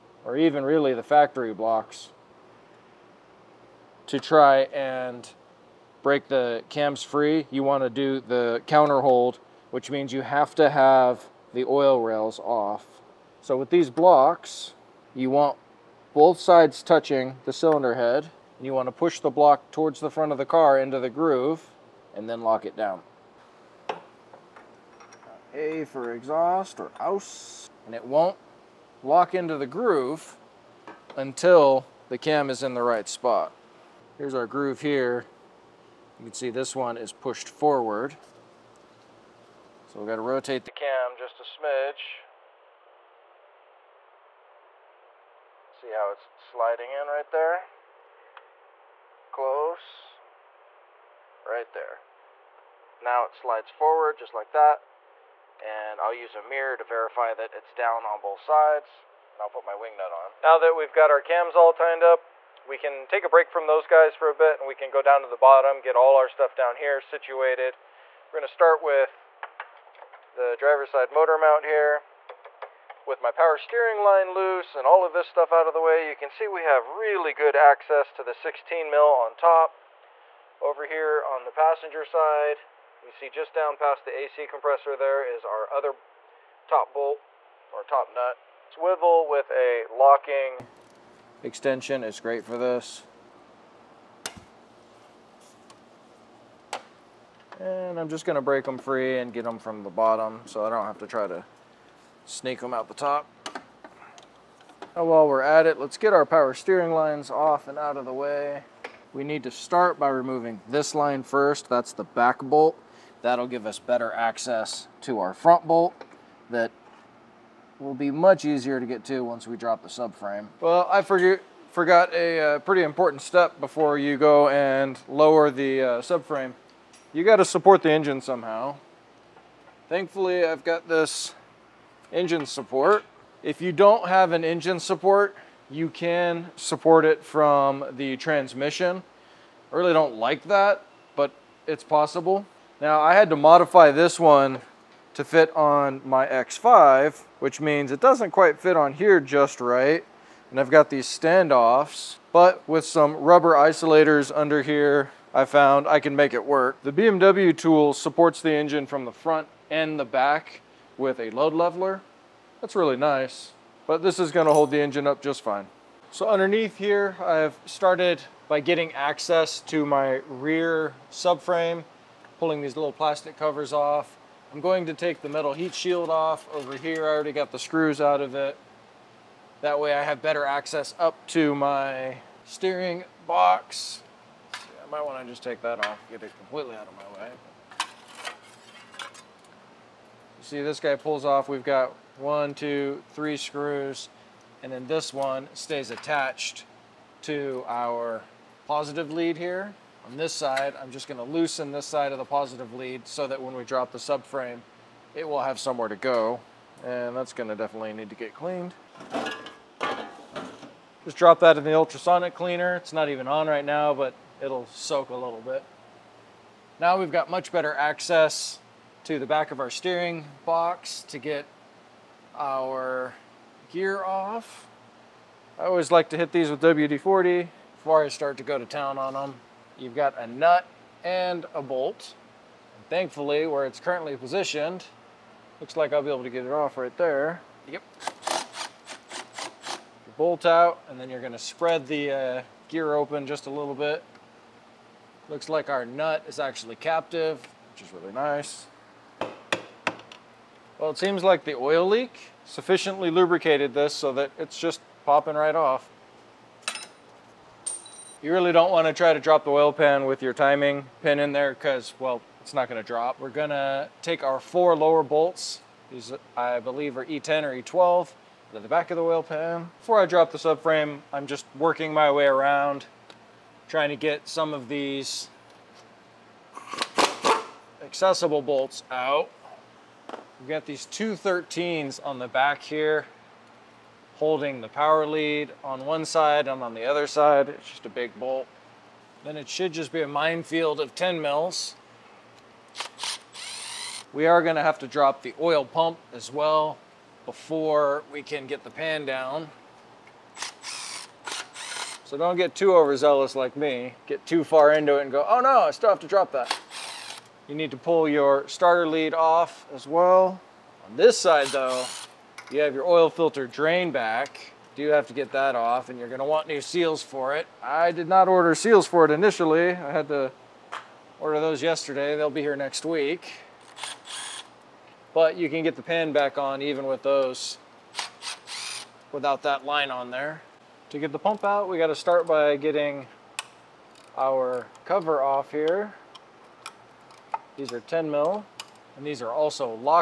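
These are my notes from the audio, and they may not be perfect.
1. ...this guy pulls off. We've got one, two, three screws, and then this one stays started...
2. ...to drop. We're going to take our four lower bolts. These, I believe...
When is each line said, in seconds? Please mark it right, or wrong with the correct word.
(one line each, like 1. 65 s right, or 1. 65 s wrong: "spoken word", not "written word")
1. 190 s wrong: "attached", not "started"
2. 262 s right.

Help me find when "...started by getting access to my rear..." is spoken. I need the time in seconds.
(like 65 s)
167 s.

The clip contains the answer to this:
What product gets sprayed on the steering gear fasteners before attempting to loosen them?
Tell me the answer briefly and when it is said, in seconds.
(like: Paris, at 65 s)
WD-40, at 226 s.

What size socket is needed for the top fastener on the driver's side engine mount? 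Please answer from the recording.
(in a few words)
16 mil.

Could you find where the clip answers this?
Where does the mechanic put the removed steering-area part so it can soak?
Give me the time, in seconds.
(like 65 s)
211 s.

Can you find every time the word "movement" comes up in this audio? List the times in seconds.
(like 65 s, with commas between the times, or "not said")
not said.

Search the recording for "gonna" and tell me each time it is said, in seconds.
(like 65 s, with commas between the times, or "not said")
68 s, 98 s, 164 s, 201 s, 207 s, 241 s, 294 s, 316 s.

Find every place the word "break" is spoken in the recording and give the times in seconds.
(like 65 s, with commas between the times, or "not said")
6 s, 63 s, 98 s.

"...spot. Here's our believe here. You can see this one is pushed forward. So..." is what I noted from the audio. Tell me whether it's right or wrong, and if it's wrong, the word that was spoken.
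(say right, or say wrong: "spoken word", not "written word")
wrong: "groove", not "believe".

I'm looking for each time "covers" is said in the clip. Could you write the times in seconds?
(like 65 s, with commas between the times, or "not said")
173 s, 334 s.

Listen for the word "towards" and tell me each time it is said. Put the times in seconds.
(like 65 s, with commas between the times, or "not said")
19 s.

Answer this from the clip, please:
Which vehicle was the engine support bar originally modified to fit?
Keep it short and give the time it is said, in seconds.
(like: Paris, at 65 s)
X5, at 146 s.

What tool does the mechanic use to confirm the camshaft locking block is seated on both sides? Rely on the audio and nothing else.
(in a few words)
a mirror.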